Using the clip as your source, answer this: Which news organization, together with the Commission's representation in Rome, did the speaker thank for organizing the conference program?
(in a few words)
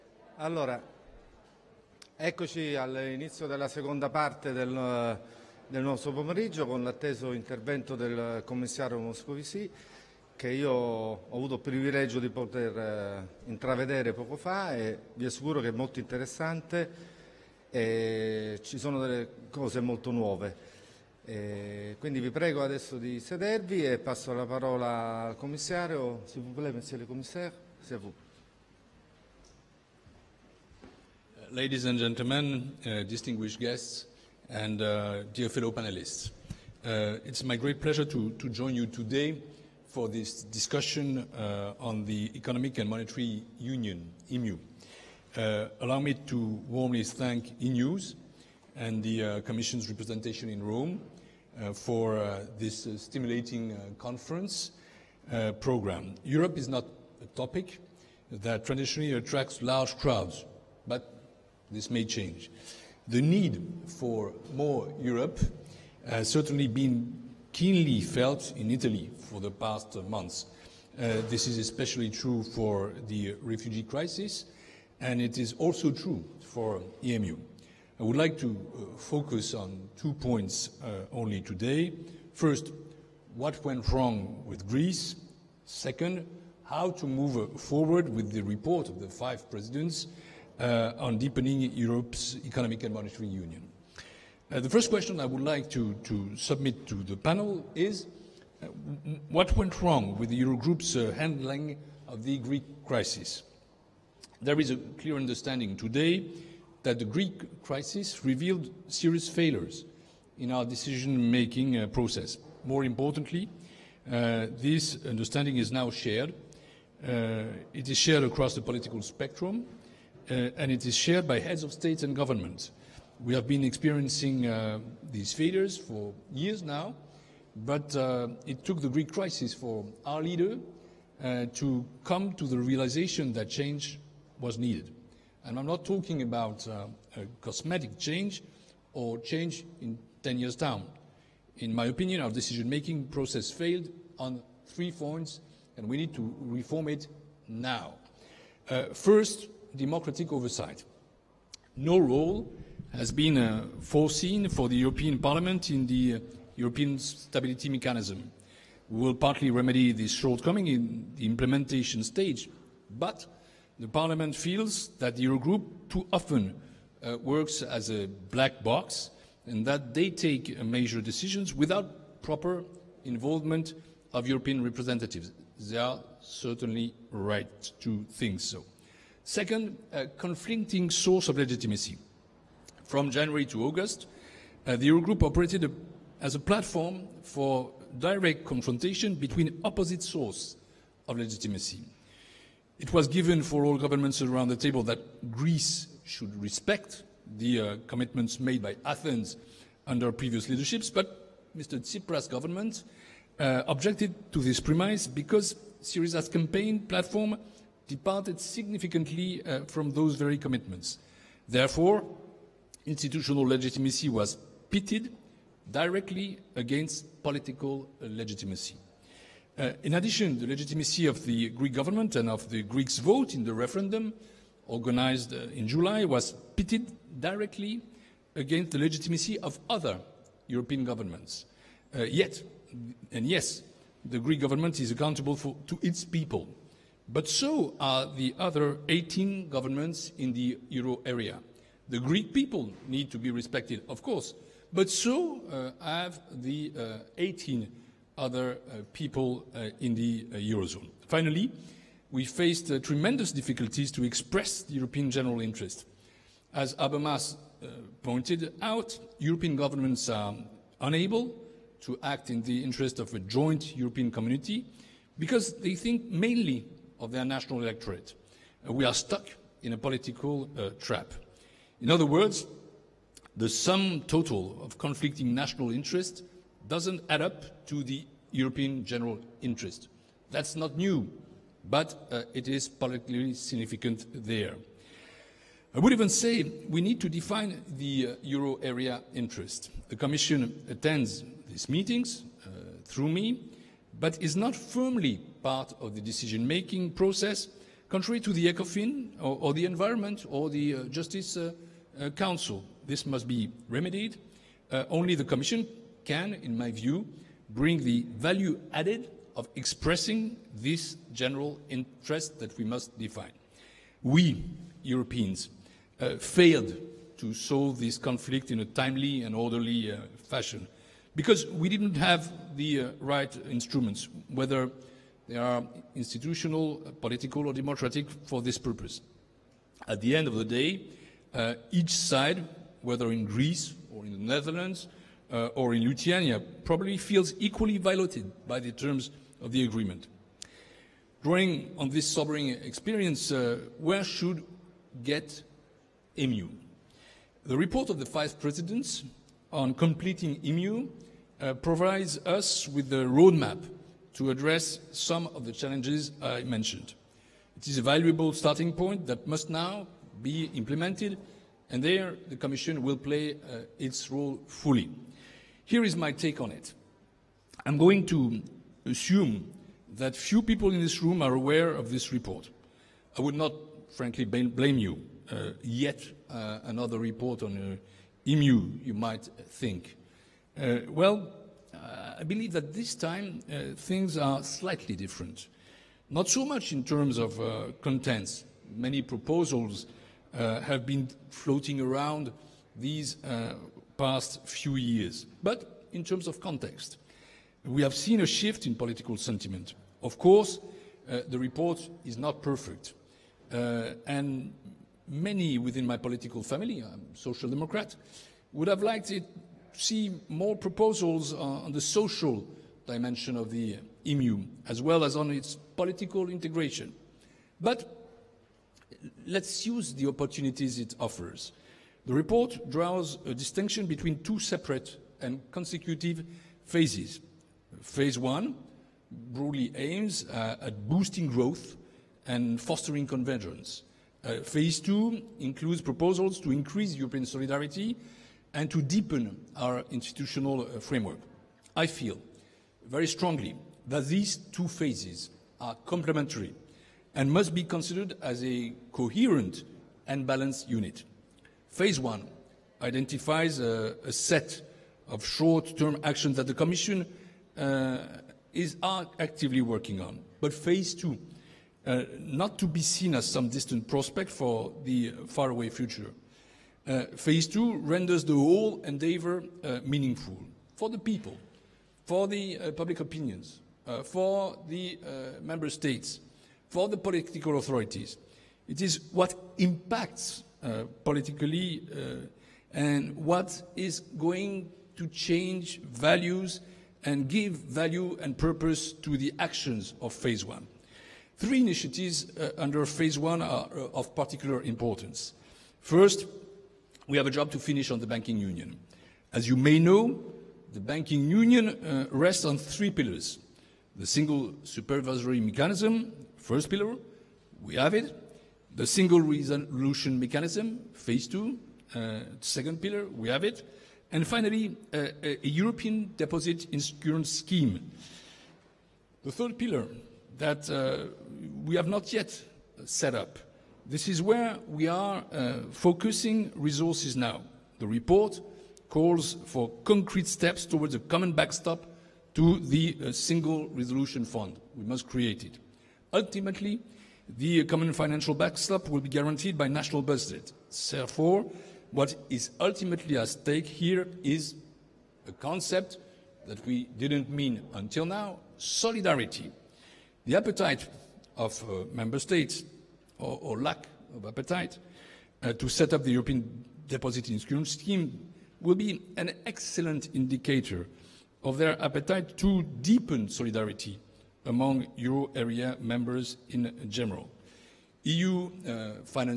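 Eunews.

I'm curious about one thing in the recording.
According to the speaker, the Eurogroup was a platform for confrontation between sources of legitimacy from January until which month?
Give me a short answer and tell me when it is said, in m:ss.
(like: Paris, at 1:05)
August, at 3:03.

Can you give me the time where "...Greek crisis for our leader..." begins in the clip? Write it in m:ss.
2:08.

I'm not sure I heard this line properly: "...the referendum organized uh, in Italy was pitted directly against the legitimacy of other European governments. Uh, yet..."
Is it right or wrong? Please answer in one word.
wrong.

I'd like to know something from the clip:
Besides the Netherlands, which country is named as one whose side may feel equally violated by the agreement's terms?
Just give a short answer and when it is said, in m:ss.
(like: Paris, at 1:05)
Lithuania, at 5:35.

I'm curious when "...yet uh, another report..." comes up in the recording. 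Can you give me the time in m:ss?
6:15.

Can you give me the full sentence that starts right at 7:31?
Phase one identifies a, a set of short-term actions that the Commission uh, is actively working on.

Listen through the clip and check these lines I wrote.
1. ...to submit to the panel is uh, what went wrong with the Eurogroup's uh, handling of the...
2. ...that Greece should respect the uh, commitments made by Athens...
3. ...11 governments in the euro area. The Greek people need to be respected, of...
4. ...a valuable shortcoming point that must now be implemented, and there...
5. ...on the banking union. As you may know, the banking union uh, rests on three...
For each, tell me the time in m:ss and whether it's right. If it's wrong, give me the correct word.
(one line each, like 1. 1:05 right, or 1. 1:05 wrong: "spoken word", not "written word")
1. 1:36 right
2. 3:14 right
3. 3:58 wrong: "18", not "11"
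4. 5:57 wrong: "starting", not "shortcoming"
5. 8:17 right.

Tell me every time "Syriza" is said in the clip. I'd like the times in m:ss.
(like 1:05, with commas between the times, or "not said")
3:25.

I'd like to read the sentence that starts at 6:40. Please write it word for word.
Of course, uh, the report is not perfect.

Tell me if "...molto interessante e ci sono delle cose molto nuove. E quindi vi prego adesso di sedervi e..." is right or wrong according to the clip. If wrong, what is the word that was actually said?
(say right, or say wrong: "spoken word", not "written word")
right.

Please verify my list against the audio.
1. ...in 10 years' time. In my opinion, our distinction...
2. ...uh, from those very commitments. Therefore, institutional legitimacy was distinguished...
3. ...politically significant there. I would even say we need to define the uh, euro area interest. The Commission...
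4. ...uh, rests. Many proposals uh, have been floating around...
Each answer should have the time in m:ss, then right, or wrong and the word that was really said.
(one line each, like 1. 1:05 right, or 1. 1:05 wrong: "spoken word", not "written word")
1. 2:19 wrong: "decision", not "distinction"
2. 3:29 wrong: "pitted", not "distinguished"
3. 4:42 right
4. 6:27 wrong: "contents", not "rests".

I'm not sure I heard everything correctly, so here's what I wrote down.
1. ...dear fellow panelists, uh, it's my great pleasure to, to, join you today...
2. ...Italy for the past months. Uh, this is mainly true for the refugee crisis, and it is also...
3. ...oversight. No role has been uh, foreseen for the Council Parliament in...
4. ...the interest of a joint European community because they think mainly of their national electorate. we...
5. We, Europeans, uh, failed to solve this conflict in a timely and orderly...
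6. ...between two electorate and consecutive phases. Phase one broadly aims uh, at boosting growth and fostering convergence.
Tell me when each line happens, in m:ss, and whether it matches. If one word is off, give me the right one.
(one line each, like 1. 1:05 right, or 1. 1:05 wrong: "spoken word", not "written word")
1. 0:35 right
2. 1:08 wrong: "especially", not "mainly"
3. 2:30 wrong: "European", not "Council"
4. 4:22 right
5. 5:14 right
6. 7:03 wrong: "separate", not "electorate".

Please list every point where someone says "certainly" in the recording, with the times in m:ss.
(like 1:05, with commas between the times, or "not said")
1:06, 2:56.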